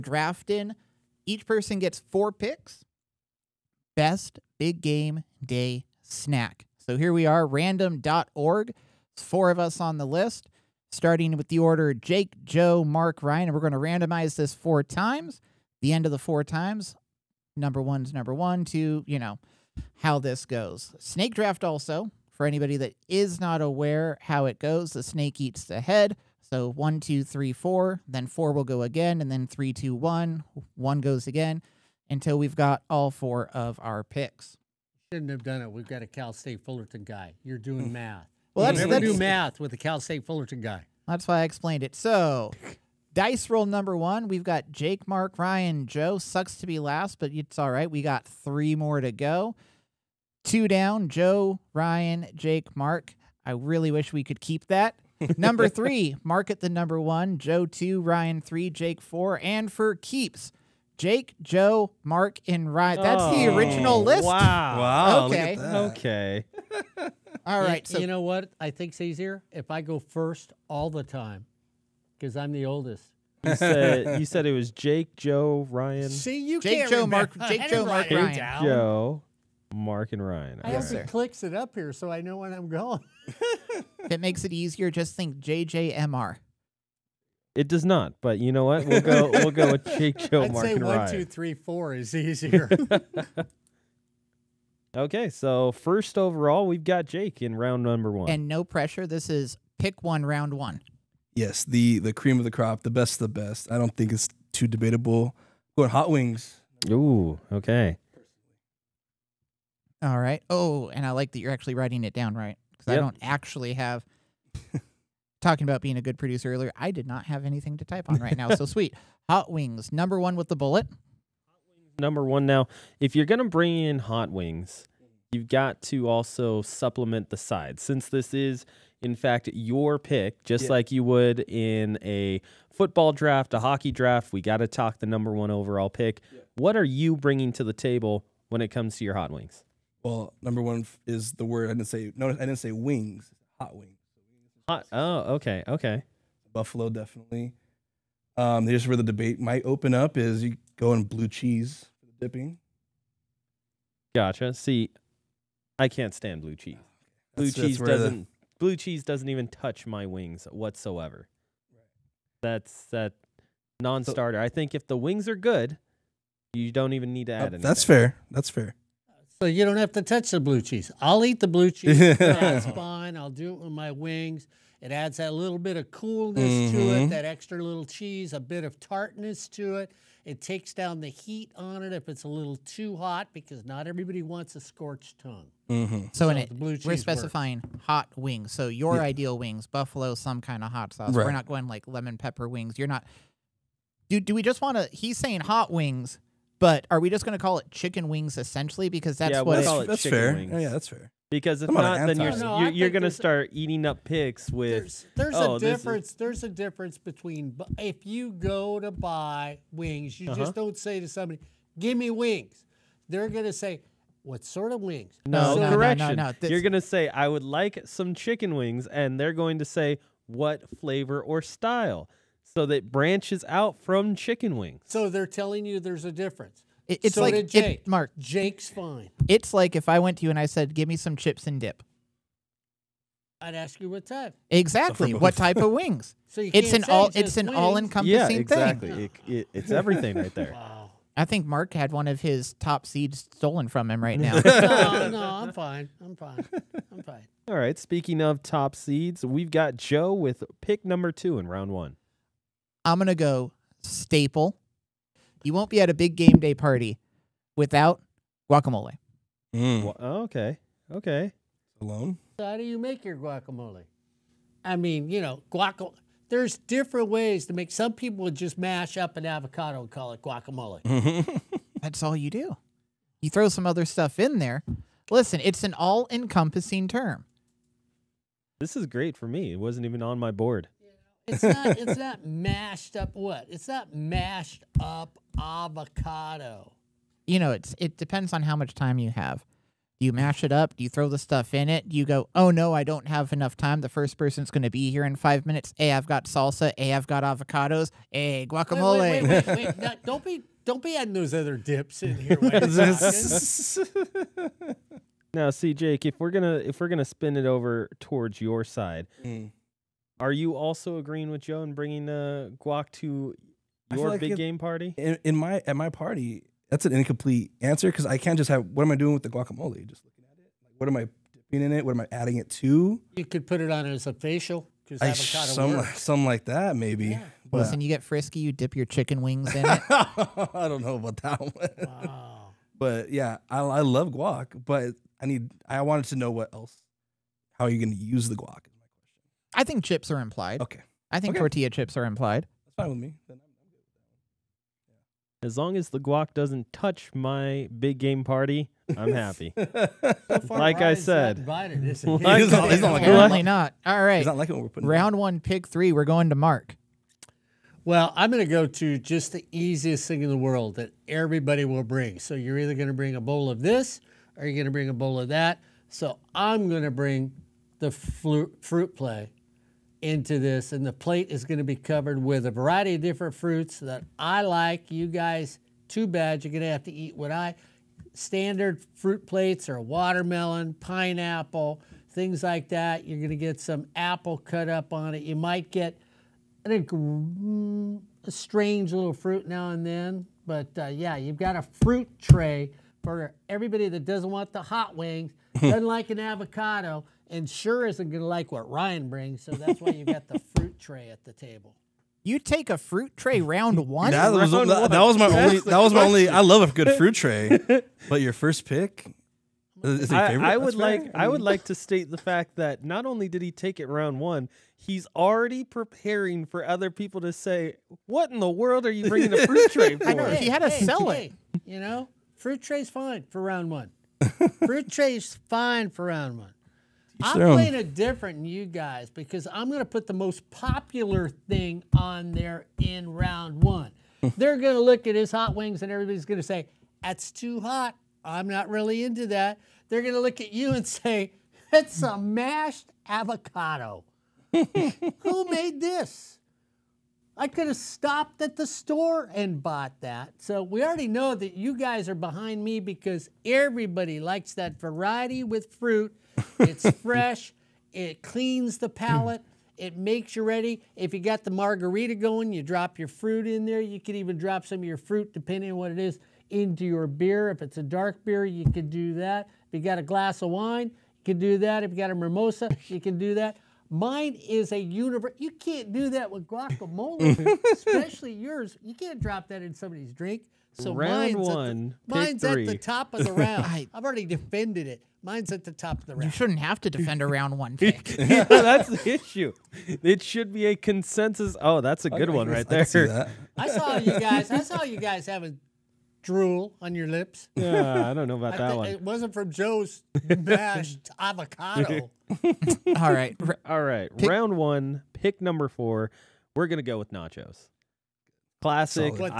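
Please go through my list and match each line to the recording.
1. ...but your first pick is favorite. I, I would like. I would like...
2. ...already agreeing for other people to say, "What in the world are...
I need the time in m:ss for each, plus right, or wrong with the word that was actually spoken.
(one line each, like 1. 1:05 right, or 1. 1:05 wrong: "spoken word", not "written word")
1. 6:48 right
2. 6:55 wrong: "preparing", not "agreeing".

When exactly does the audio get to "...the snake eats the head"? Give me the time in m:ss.
0:24.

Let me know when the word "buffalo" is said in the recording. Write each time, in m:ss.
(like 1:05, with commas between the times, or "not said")
2:26, 3:09.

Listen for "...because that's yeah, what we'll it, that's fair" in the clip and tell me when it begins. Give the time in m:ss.
3:18.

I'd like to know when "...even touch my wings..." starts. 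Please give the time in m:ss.
2:39.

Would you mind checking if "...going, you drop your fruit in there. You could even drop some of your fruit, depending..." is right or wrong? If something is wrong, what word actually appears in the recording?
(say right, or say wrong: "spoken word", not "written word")
right.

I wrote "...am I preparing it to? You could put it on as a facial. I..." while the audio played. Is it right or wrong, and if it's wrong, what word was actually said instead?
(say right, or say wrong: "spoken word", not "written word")
wrong: "adding", not "preparing".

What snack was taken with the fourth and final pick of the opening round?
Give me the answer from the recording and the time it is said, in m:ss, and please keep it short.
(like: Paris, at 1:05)
Nachos, at 8:27.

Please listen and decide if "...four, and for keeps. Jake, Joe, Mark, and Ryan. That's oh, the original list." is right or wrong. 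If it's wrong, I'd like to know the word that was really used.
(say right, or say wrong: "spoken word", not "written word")
right.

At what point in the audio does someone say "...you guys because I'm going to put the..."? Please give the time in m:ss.
7:08.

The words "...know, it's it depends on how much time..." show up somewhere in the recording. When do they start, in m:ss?
4:47.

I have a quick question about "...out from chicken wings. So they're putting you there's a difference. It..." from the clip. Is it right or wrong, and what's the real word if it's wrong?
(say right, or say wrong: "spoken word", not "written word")
wrong: "telling", not "putting".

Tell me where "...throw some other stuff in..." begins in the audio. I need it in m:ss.
4:33.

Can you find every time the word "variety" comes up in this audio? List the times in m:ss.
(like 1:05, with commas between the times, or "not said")
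6:12, 7:34.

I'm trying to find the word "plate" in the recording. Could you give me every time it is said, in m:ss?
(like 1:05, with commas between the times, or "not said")
6:10, 6:19.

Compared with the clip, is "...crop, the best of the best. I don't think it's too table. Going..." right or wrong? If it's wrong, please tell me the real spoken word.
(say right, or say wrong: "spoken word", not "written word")
wrong: "debatable", not "table".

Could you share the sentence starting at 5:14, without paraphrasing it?
In, in, my at my party, that's an incomplete answer because I can't just have.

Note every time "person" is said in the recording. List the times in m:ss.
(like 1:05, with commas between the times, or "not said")
0:01, 4:54.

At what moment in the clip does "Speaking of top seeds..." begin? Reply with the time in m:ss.
4:07.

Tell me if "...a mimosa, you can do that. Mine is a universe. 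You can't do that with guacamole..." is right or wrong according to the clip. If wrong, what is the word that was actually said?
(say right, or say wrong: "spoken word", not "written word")
right.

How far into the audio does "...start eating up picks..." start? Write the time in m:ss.
3:23.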